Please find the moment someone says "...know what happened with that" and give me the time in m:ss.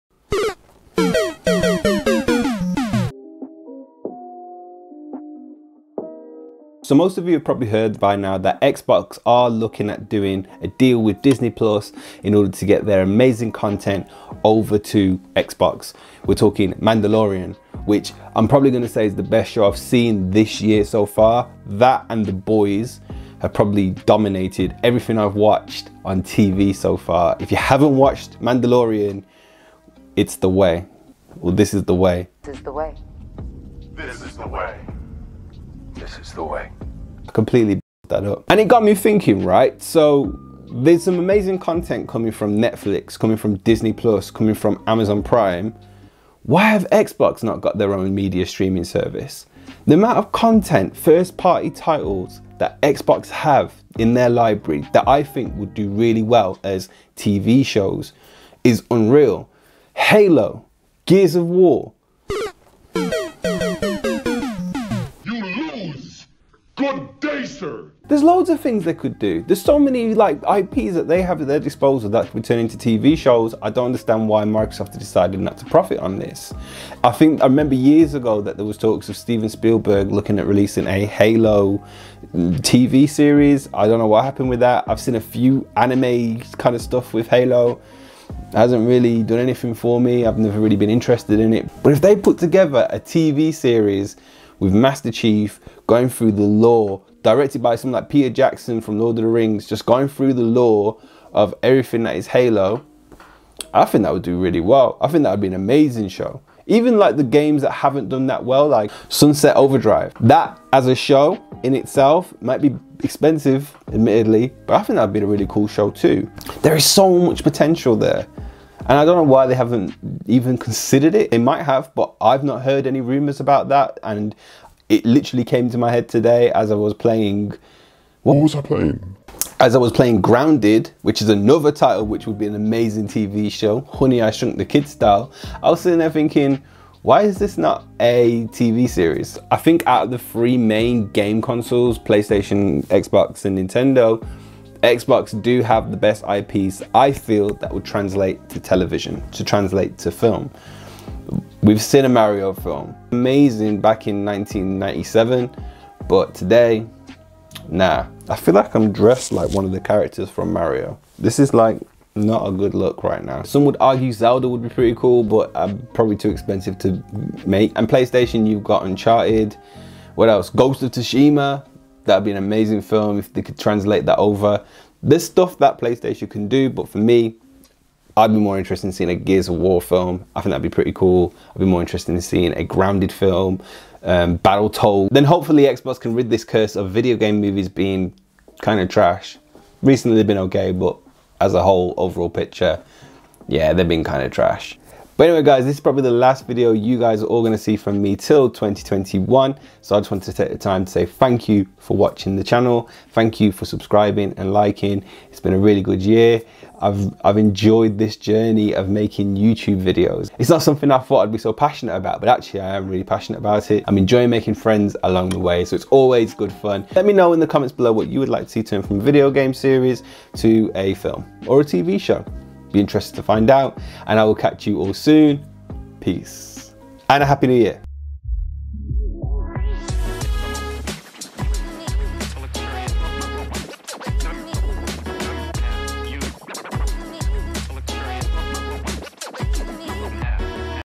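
1:23.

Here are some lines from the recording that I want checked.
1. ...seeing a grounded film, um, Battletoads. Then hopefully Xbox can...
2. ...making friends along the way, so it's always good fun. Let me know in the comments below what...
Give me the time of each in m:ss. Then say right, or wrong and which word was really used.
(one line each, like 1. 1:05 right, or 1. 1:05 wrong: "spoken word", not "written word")
1. 3:02 right
2. 3:34 right.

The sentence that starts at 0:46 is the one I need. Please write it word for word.
Why have Xbox not got their own media streaming service?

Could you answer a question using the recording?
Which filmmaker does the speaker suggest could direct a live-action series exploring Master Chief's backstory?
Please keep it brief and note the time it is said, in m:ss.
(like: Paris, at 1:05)
Peter Jackson, at 1:38.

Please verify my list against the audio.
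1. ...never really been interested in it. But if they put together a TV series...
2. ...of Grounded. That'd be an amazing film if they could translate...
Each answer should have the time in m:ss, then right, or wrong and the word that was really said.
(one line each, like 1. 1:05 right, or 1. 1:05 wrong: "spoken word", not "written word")
1. 1:30 right
2. 2:50 wrong: "Tsushima", not "Grounded".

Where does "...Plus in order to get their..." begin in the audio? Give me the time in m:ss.
0:11.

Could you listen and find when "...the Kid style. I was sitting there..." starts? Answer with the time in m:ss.
2:14.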